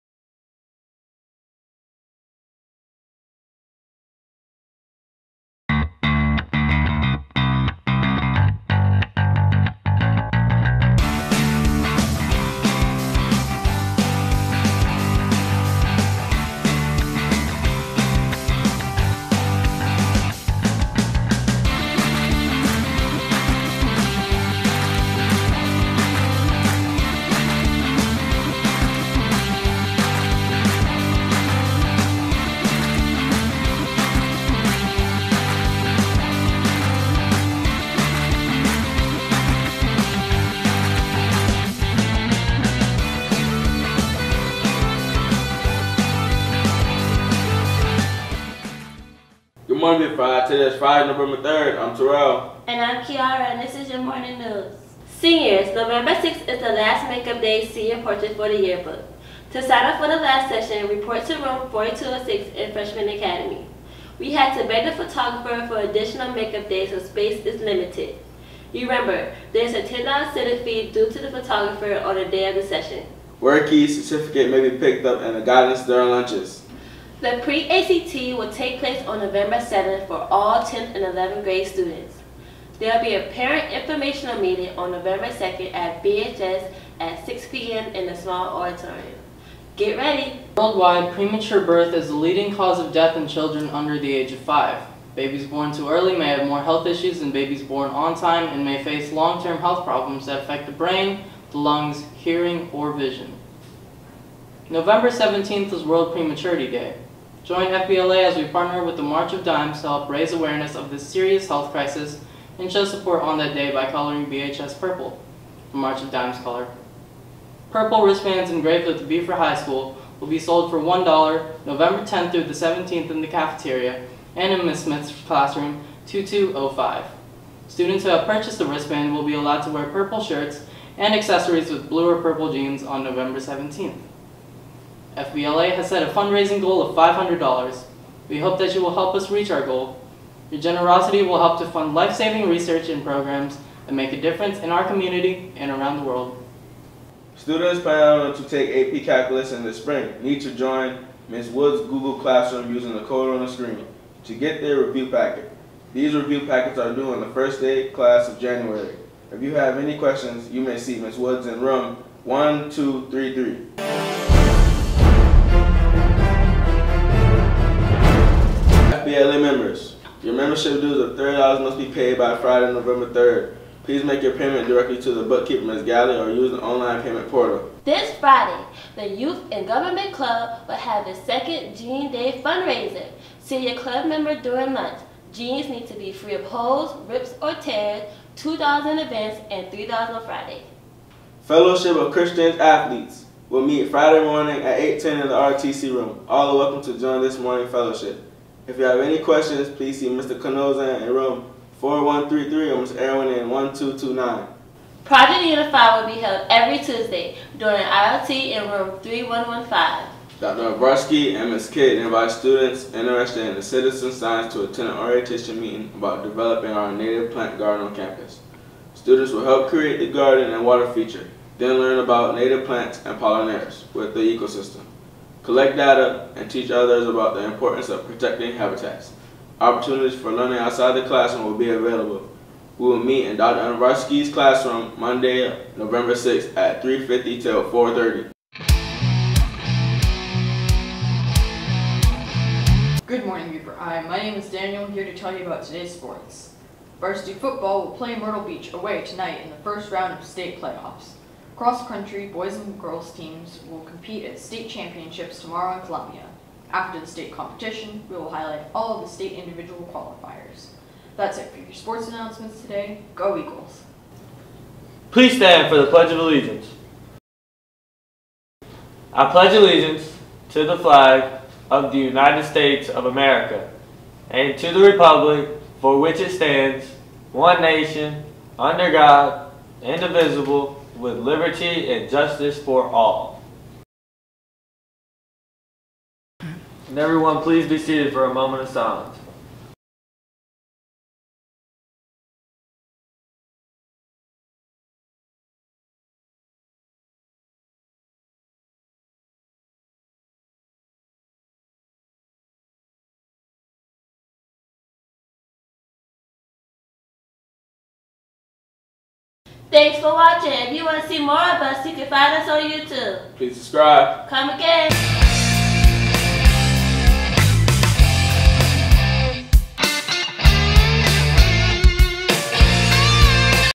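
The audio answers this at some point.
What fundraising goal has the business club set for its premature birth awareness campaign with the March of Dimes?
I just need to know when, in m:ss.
2:16.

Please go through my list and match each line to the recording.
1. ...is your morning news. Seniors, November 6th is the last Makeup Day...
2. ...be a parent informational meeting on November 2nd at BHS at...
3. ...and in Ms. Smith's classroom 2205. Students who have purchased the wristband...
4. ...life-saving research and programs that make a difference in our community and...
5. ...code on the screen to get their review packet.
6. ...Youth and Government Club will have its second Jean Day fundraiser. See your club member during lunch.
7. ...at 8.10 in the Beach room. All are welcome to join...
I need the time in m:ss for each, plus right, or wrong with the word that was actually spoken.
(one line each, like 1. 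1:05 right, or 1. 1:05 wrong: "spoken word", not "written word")
1. 0:53 right
2. 1:23 right
3. 2:04 right
4. 2:21 right
5. 2:33 right
6. 2:59 right
7. 3:14 wrong: "RTC", not "Beach".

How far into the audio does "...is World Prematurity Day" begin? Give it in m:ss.
1:45.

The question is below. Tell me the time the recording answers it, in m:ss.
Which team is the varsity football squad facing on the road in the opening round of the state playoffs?
4:08.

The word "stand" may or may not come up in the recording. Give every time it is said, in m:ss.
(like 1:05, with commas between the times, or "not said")
4:25, 4:36.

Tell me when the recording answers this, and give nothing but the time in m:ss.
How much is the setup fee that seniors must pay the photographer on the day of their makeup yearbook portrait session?
1:09.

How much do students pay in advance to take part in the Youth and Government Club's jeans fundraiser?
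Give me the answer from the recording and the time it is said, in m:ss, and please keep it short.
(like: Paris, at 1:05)
$2, at 3:08.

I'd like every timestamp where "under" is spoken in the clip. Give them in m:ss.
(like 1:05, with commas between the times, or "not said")
1:33, 4:38.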